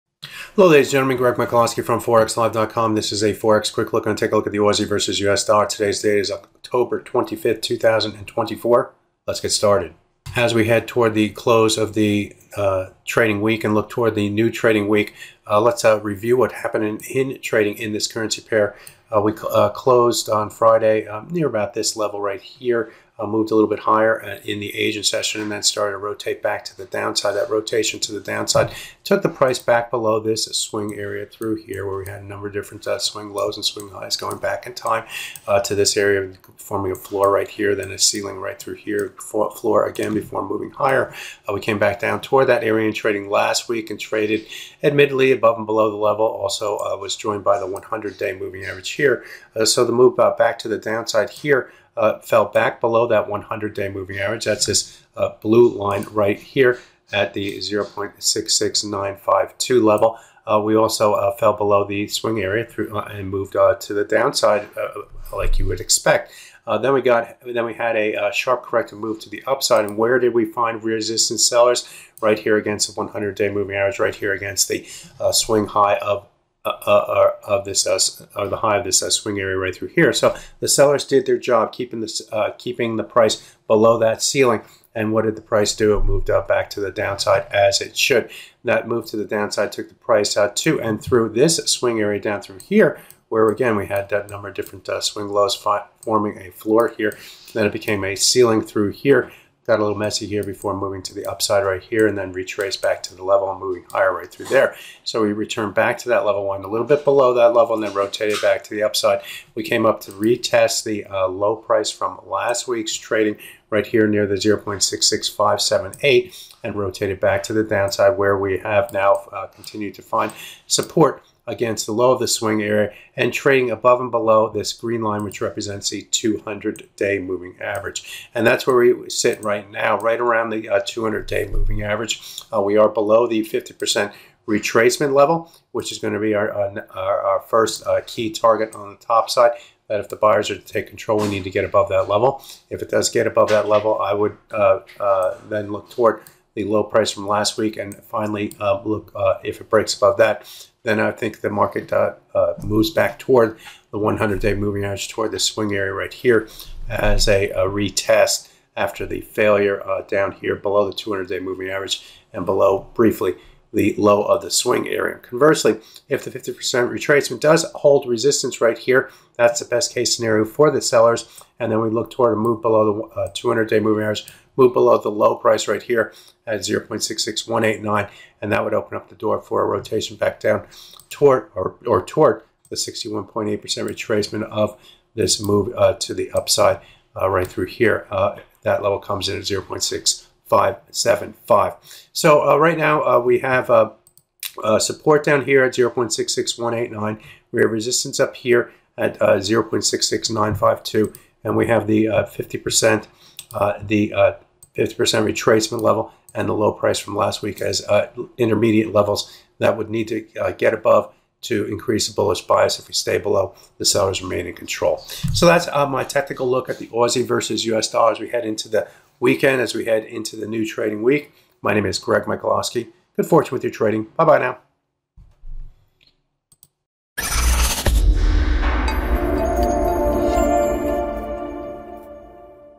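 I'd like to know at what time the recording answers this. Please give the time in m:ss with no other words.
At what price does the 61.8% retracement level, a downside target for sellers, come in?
3:09.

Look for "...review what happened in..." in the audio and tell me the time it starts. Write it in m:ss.
0:16.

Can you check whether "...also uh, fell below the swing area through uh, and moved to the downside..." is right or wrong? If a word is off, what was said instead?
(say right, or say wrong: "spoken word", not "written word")
right.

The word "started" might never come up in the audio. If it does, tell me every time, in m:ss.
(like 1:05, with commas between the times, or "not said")
0:09, 0:25.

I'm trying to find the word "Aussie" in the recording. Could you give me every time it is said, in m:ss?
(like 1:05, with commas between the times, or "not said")
0:04, 3:36.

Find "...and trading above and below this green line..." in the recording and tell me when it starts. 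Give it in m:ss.
2:03.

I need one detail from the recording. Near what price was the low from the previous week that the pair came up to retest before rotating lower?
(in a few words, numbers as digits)
0.66578.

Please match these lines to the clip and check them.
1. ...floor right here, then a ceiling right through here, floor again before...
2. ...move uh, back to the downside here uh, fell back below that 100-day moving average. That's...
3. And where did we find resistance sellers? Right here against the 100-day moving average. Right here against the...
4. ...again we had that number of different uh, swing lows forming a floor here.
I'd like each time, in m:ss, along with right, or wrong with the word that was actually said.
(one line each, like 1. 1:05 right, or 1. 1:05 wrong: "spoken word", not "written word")
1. 0:36 right
2. 0:49 right
3. 1:09 right
4. 1:33 right.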